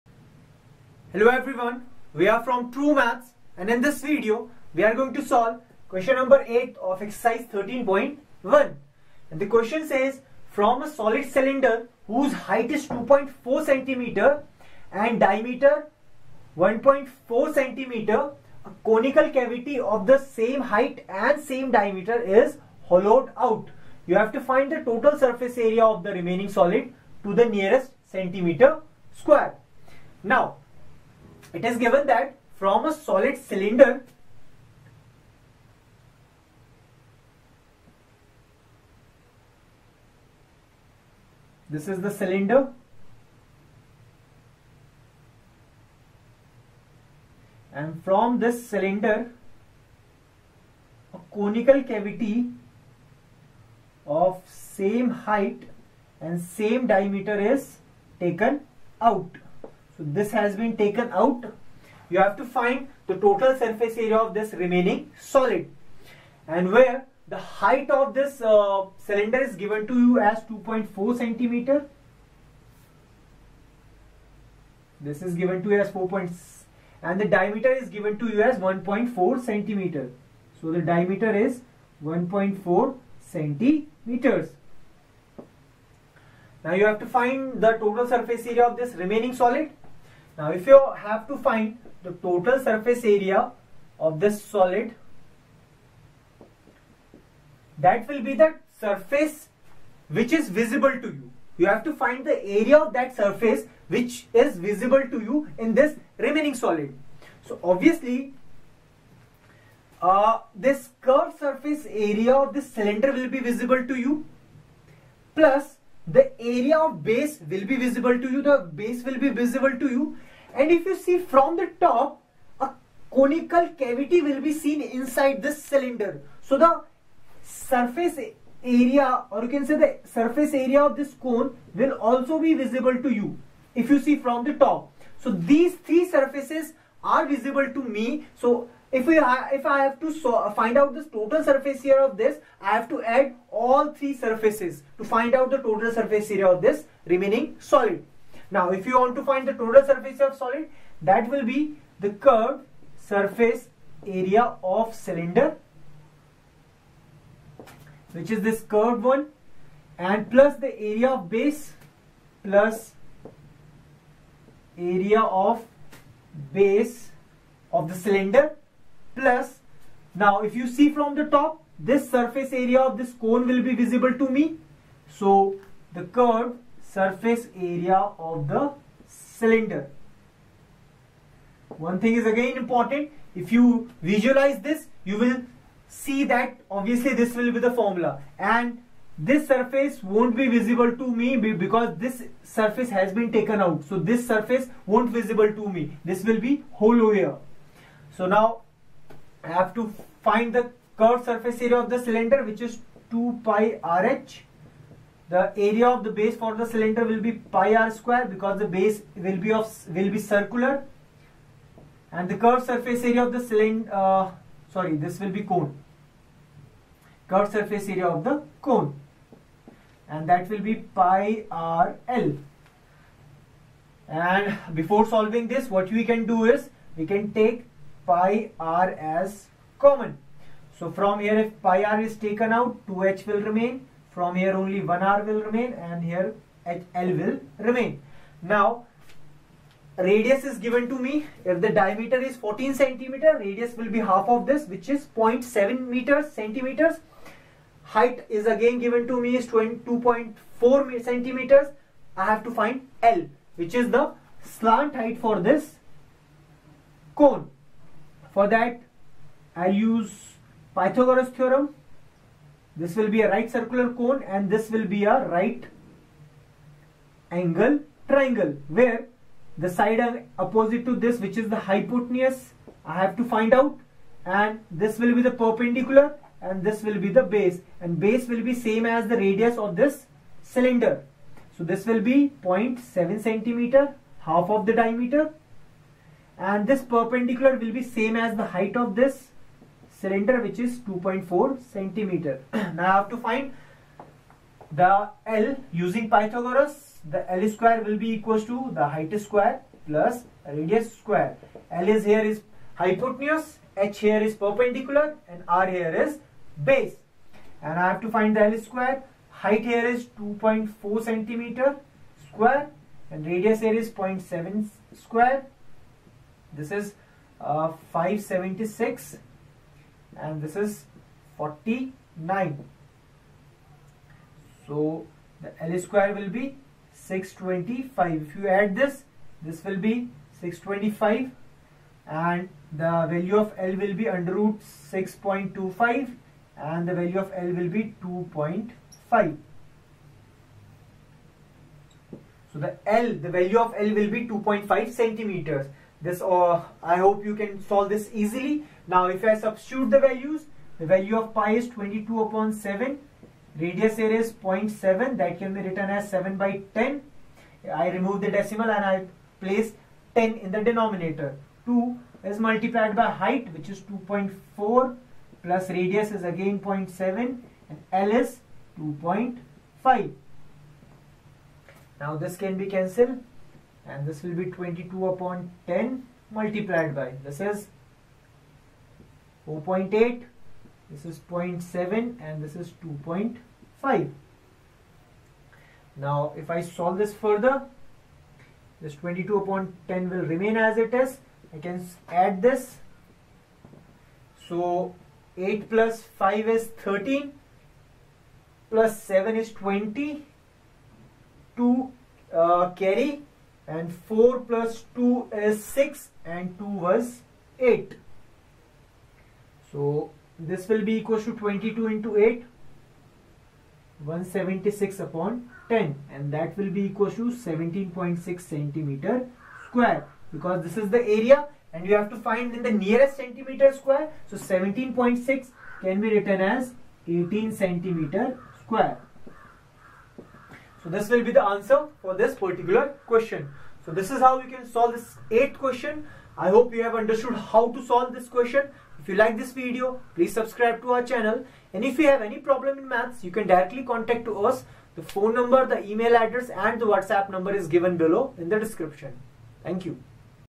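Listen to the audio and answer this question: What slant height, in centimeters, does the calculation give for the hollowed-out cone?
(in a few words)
2.5 centimeters.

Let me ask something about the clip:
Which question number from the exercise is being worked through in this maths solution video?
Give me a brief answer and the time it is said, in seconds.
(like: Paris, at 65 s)
8, at 5 s.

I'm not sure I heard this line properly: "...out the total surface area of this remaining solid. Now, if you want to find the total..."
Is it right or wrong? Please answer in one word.
right.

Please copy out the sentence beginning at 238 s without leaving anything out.
Now radius is given to me.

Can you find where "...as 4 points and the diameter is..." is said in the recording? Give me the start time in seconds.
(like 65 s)
75 s.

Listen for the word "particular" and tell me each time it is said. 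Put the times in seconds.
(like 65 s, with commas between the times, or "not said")
432 s.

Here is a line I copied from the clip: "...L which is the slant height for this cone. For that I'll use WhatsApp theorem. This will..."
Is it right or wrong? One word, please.
wrong.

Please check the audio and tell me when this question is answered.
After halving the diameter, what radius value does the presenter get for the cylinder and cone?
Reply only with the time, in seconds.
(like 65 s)
245 s.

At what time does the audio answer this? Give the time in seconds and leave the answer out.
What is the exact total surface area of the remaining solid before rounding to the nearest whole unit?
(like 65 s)
417 s.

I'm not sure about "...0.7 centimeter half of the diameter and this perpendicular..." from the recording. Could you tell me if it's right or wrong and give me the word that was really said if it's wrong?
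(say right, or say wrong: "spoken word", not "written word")
right.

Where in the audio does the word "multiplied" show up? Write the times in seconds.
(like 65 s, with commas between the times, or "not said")
362 s, 376 s.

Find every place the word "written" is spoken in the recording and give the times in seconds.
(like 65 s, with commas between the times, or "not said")
355 s, 426 s.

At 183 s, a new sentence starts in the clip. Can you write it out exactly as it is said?
If you visualize this, you will see that obviously this will be the formula.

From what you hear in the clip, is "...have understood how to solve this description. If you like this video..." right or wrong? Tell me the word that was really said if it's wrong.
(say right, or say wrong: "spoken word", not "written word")
wrong: "question", not "description".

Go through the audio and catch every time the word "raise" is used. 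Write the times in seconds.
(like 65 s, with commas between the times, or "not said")
not said.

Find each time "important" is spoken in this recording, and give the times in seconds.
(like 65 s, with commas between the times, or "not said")
182 s.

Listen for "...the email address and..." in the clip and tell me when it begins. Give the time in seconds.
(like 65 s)
445 s.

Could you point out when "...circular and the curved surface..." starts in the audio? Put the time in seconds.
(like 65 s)
210 s.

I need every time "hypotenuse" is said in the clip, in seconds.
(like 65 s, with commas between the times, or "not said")
271 s, 302 s.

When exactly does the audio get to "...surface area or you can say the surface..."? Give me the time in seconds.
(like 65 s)
127 s.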